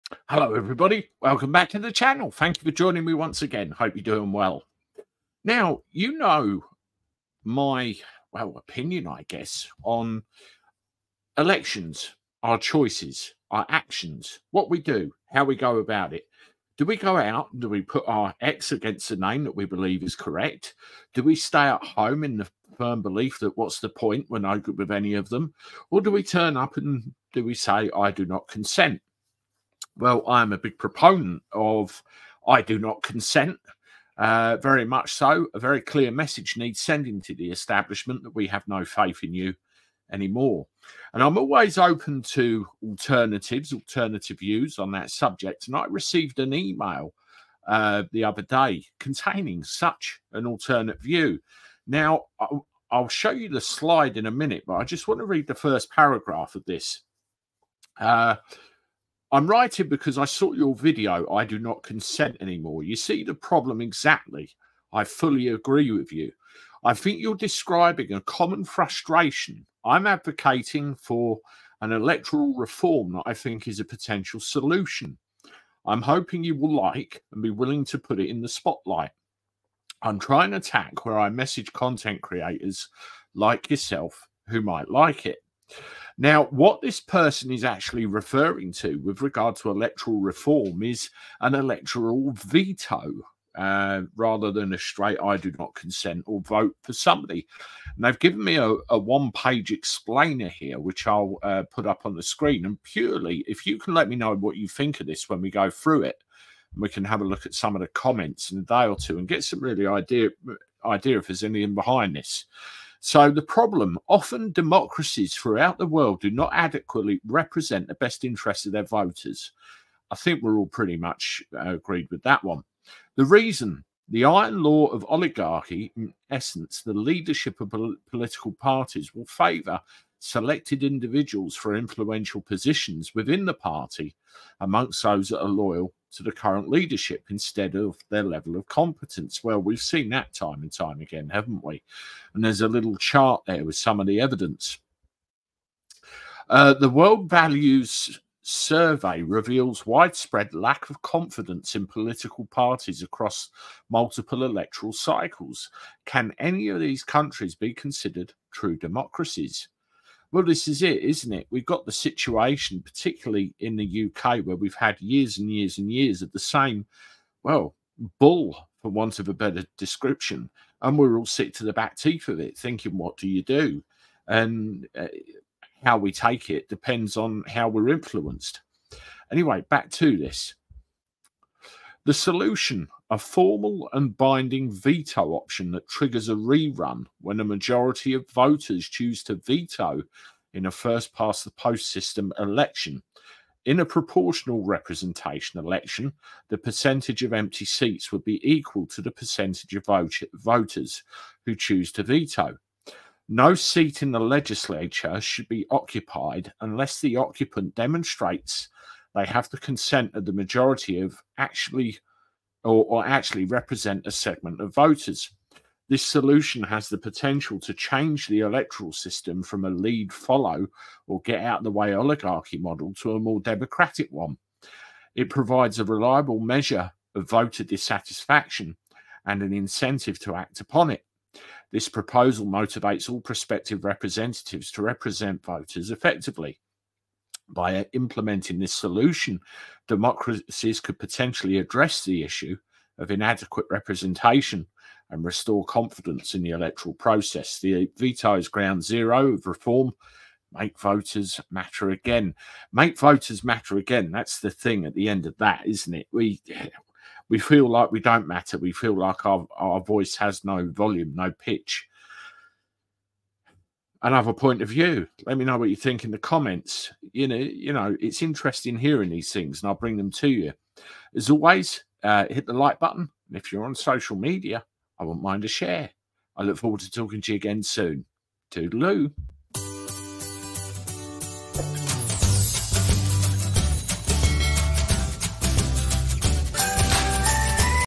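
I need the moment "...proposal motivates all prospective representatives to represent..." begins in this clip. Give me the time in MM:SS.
03:51.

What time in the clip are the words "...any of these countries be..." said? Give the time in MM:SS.
02:36.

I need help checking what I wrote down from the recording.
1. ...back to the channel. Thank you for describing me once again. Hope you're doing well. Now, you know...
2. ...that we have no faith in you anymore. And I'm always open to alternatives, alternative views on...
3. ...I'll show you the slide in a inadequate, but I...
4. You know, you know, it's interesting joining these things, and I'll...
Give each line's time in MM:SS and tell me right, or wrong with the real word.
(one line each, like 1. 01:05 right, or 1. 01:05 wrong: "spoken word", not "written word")
1. 00:01 wrong: "joining", not "describing"
2. 00:38 right
3. 00:52 wrong: "minute", not "inadequate"
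4. 04:27 wrong: "hearing", not "joining".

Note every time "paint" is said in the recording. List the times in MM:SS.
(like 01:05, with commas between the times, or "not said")
not said.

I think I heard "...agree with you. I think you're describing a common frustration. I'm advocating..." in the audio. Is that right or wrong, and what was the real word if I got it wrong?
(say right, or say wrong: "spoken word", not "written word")
right.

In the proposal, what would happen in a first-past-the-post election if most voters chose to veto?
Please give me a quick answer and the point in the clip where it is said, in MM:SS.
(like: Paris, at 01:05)
A rerun, at 03:06.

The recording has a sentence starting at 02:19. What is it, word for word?
Well, we've seen that time and time again, haven't we?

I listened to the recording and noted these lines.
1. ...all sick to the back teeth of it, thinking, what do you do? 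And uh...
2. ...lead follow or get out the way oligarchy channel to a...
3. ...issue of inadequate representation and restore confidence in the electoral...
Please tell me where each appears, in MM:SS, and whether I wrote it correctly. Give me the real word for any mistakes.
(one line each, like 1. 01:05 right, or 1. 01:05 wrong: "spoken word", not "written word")
1. 02:51 right
2. 03:39 wrong: "model", not "channel"
3. 04:02 right.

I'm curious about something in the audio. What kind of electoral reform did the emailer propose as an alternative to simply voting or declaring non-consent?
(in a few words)
Electoral veto.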